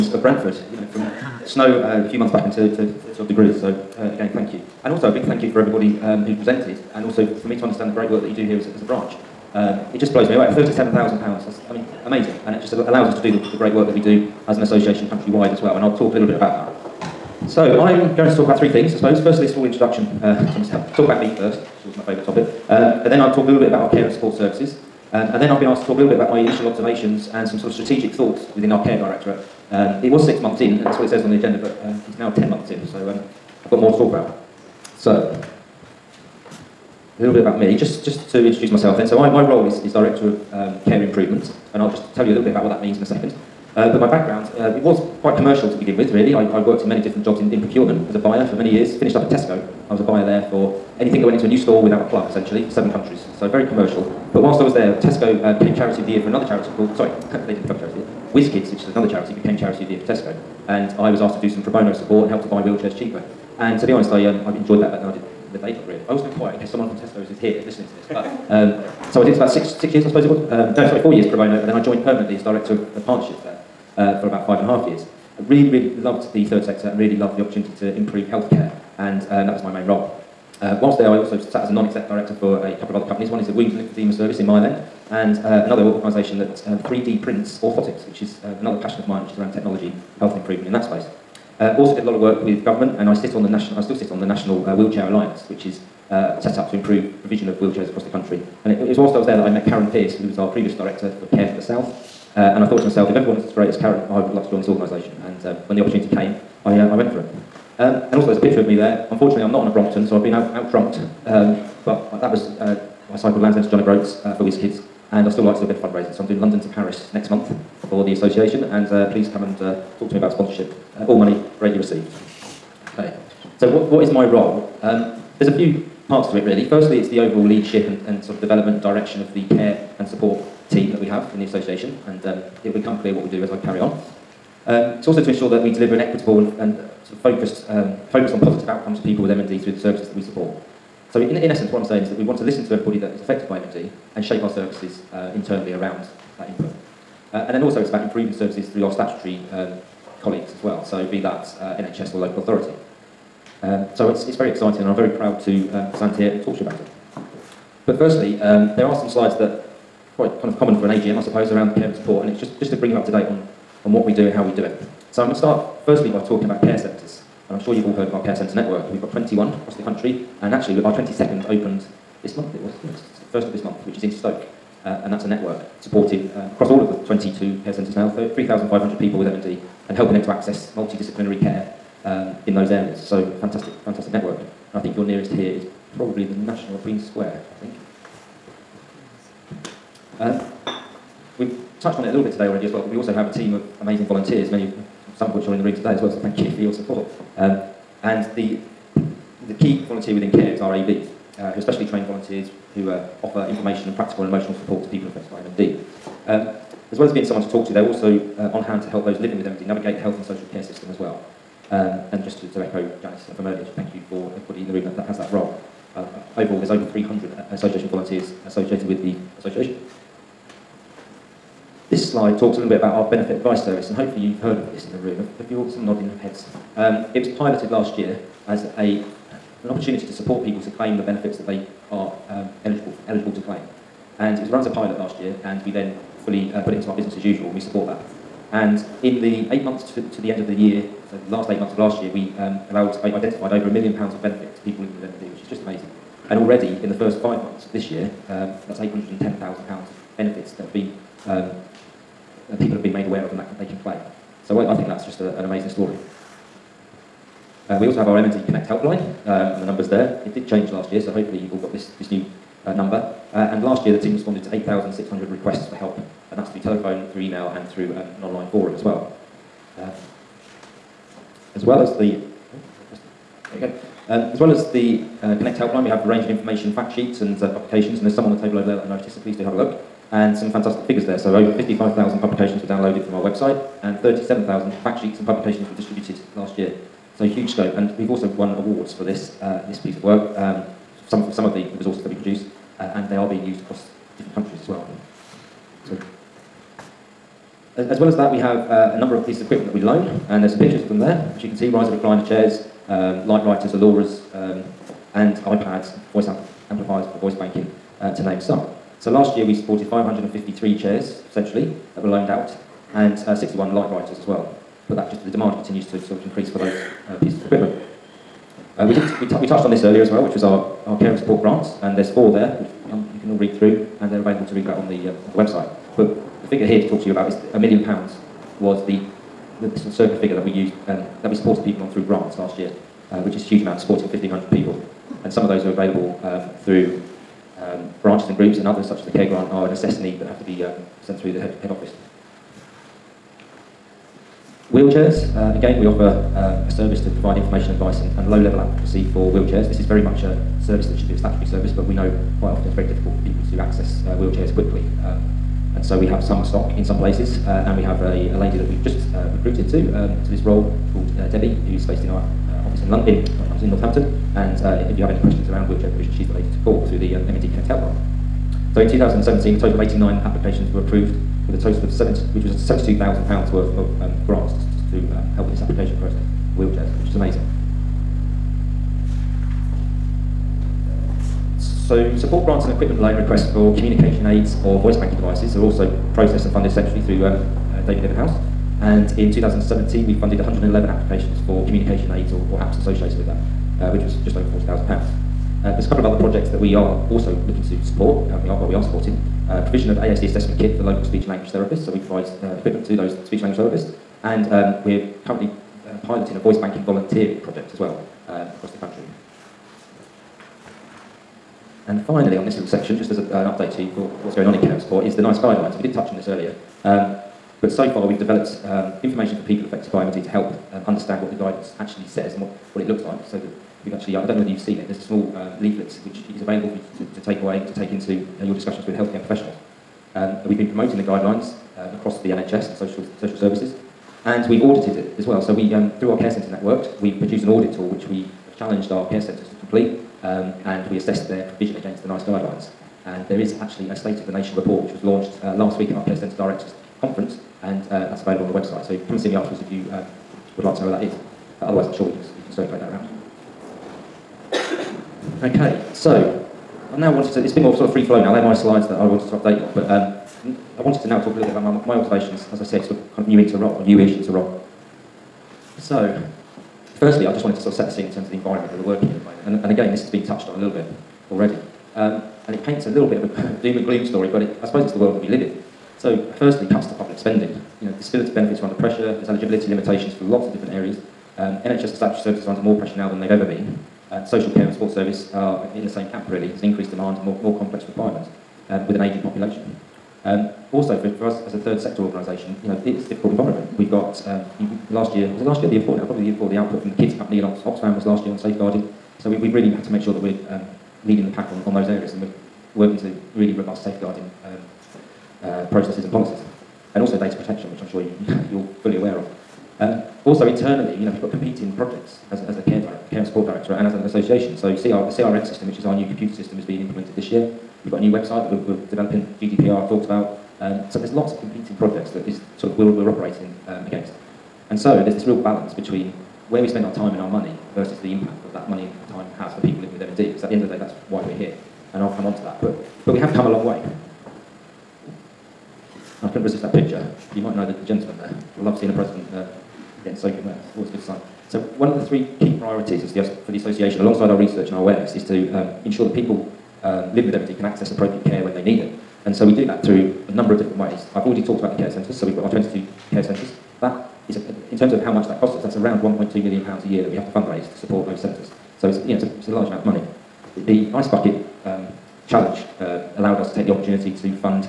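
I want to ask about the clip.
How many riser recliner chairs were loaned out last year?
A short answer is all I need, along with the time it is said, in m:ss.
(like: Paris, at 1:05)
553, at 5:09.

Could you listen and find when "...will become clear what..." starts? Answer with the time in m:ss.
2:12.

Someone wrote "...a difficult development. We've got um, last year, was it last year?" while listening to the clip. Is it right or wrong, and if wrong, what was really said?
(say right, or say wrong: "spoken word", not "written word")
wrong: "environment", not "development".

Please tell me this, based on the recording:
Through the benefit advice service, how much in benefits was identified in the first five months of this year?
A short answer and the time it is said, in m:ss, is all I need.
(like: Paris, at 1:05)
£810,000, at 4:08.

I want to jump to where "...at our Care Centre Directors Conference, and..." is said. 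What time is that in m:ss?
7:25.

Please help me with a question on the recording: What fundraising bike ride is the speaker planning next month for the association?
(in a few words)
London to Paris.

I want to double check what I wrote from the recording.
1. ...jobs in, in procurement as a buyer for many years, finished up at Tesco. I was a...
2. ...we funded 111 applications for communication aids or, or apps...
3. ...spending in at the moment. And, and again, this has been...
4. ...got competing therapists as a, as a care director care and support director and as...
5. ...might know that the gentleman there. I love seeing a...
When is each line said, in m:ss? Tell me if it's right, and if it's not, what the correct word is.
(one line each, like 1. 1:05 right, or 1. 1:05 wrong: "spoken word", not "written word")
1. 0:47 right
2. 6:30 right
3. 7:48 wrong: "working", not "spending"
4. 8:31 wrong: "projects", not "therapists"
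5. 8:57 right.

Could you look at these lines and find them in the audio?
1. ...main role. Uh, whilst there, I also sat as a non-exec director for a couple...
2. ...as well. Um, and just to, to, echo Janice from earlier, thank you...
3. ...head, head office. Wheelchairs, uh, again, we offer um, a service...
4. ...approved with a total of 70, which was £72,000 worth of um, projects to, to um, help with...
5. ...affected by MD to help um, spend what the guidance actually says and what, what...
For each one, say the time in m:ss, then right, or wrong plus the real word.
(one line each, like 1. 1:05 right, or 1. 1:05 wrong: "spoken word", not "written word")
1. 1:19 right
2. 3:30 right
3. 5:41 right
4. 6:10 wrong: "grants", not "projects"
5. 6:59 wrong: "understand", not "spend".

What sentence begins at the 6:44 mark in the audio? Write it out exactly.
And um, we're currently uh, piloting a voice banking volunteering project as well uh, across the country.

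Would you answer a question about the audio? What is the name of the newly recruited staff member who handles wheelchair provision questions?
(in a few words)
Debbie.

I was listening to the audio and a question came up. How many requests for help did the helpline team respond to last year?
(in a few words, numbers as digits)
8,600.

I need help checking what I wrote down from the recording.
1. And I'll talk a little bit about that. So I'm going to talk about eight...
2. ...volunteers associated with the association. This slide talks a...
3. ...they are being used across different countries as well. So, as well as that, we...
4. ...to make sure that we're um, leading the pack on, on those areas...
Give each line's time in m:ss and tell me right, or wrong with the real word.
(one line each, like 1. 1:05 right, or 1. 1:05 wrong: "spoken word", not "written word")
1. 0:15 wrong: "three", not "eight"
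2. 3:37 right
3. 4:53 right
4. 8:19 right.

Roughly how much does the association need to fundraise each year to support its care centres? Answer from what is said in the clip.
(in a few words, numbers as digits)
£1.2 million.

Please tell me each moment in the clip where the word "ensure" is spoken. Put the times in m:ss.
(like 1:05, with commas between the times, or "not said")
2:15, 9:05.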